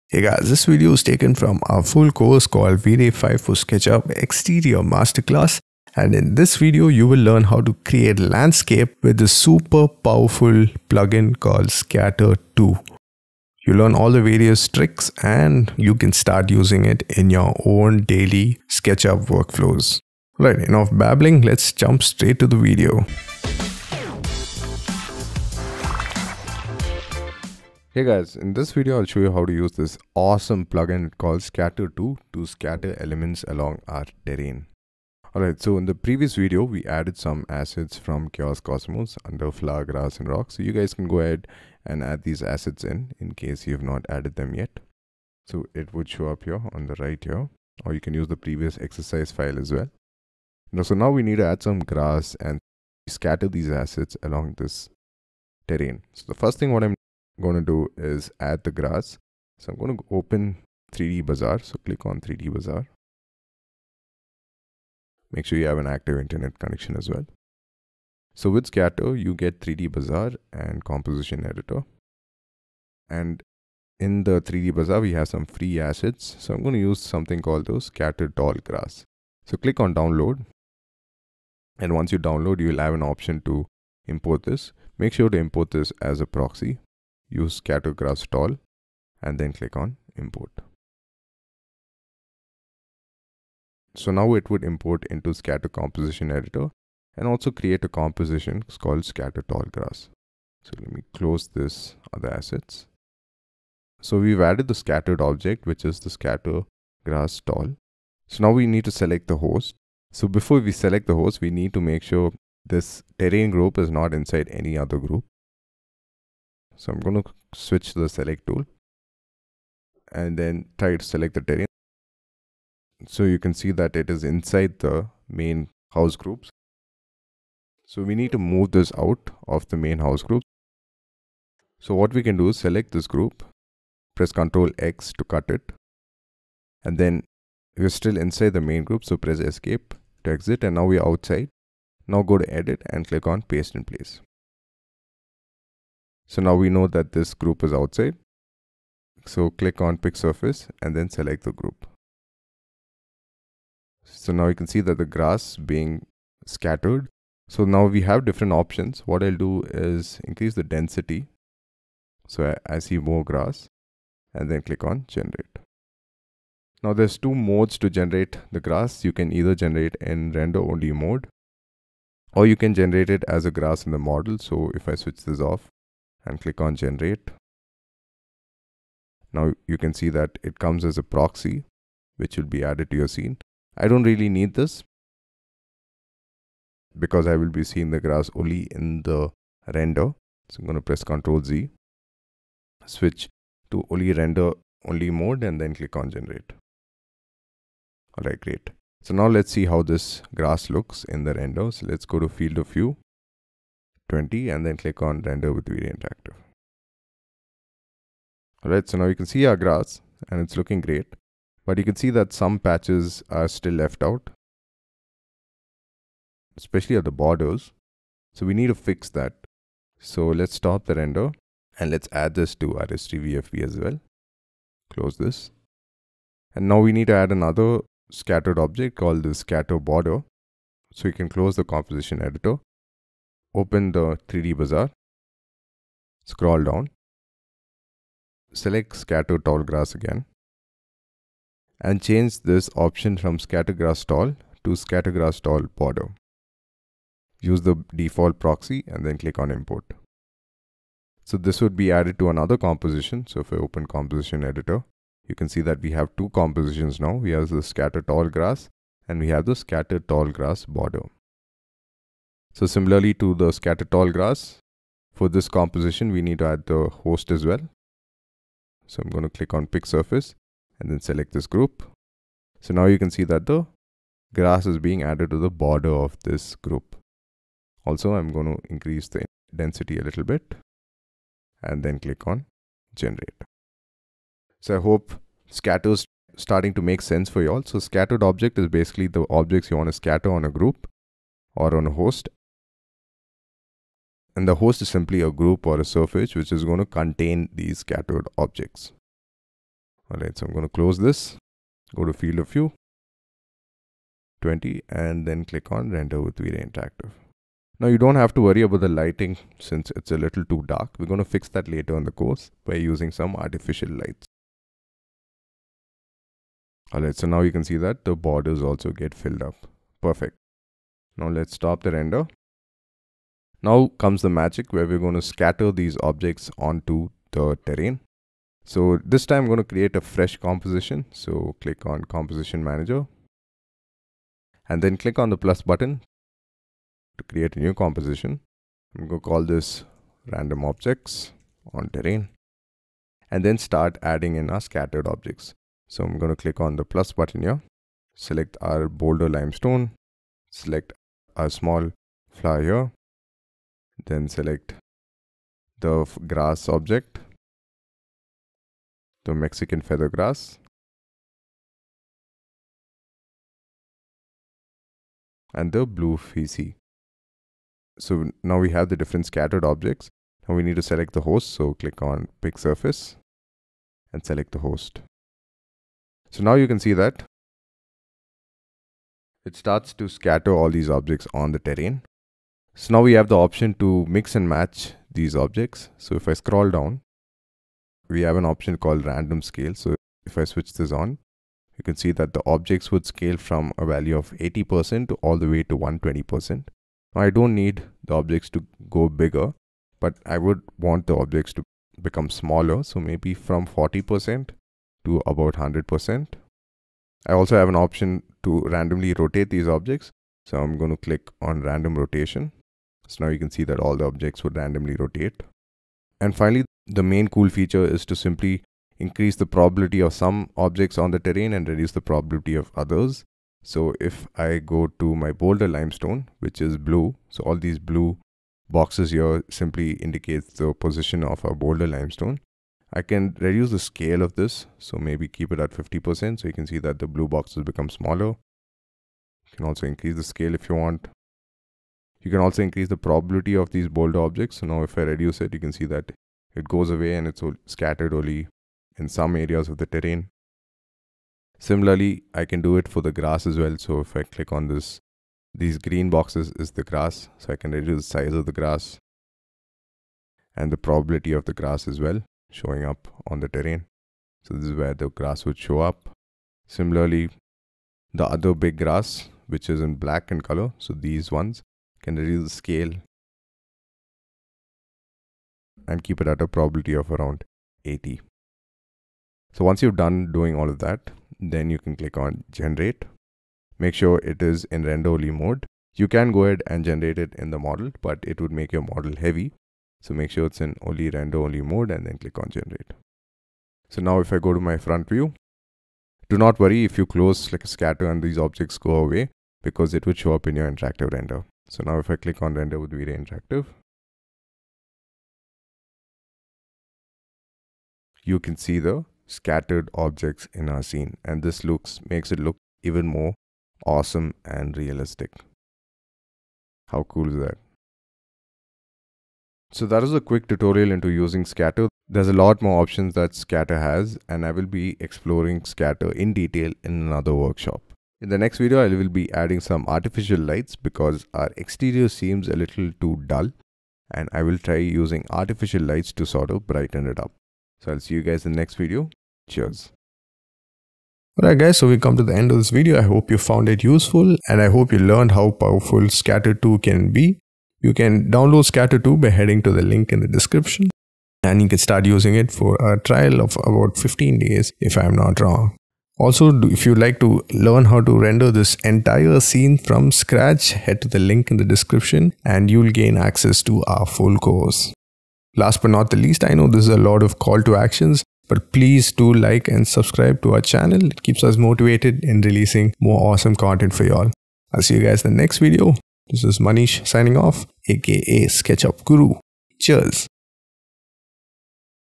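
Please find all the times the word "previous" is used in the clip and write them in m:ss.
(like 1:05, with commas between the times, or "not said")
0:35, 0:48.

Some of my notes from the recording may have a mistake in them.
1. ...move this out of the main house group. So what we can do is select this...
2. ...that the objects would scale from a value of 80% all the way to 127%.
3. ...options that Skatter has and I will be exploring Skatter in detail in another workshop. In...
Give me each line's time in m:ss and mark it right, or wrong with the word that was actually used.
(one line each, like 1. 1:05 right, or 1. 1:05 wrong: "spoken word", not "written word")
1. 2:08 right
2. 6:32 wrong: "120", not "127"
3. 8:42 right.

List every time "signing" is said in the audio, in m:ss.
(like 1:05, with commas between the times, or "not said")
9:37.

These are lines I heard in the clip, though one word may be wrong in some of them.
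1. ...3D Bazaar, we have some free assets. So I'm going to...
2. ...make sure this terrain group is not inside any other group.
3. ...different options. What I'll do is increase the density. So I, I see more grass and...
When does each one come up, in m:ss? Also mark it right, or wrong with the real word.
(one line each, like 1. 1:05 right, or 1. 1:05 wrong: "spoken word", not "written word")
1. 1:14 right
2. 1:51 right
3. 2:38 right.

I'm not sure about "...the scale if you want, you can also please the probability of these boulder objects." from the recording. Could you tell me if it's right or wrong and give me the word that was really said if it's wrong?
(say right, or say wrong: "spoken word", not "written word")
wrong: "increase", not "please".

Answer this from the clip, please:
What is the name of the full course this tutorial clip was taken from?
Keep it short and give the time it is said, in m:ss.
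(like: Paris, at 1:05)
V-Ray 5 for SketchUp Exterior Masterclass, at 0:02.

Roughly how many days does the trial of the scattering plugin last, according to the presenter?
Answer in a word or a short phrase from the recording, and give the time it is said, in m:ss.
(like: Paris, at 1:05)
15, at 9:13.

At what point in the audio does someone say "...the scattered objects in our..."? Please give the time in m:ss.
8:28.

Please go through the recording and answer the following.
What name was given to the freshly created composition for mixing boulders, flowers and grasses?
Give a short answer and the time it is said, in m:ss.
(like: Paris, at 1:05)
random objects on terrain, at 5:40.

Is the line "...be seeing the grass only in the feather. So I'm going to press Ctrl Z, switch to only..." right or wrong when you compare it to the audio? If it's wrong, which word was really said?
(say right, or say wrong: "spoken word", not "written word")
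wrong: "render", not "feather".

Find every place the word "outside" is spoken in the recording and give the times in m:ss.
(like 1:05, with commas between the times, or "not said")
2:21, 2:27.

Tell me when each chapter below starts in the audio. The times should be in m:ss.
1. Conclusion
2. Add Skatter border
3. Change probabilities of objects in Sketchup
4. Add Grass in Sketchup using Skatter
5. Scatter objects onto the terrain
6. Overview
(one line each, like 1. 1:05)
1. 9:00
2. 3:47
3. 6:56
4. 0:56
5. 5:23
6. 0:28.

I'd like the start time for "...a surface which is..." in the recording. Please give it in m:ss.
4:55.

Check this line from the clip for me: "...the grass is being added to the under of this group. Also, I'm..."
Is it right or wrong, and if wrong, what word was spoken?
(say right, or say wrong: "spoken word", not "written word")
wrong: "border", not "under".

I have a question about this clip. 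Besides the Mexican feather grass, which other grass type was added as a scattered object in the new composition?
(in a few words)
Blue fescue.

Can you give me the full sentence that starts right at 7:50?
So these ones, can reduce the scale and keep it at a probability of around 80.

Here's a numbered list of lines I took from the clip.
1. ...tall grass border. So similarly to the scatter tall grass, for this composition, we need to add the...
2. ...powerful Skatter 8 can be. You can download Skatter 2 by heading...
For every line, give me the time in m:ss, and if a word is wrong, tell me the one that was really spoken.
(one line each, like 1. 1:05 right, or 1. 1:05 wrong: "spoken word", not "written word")
1. 4:19 right
2. 9:05 wrong: "2", not "8".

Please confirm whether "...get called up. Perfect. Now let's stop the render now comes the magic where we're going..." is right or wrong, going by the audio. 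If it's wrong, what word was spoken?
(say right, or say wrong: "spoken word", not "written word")
wrong: "filled", not "called".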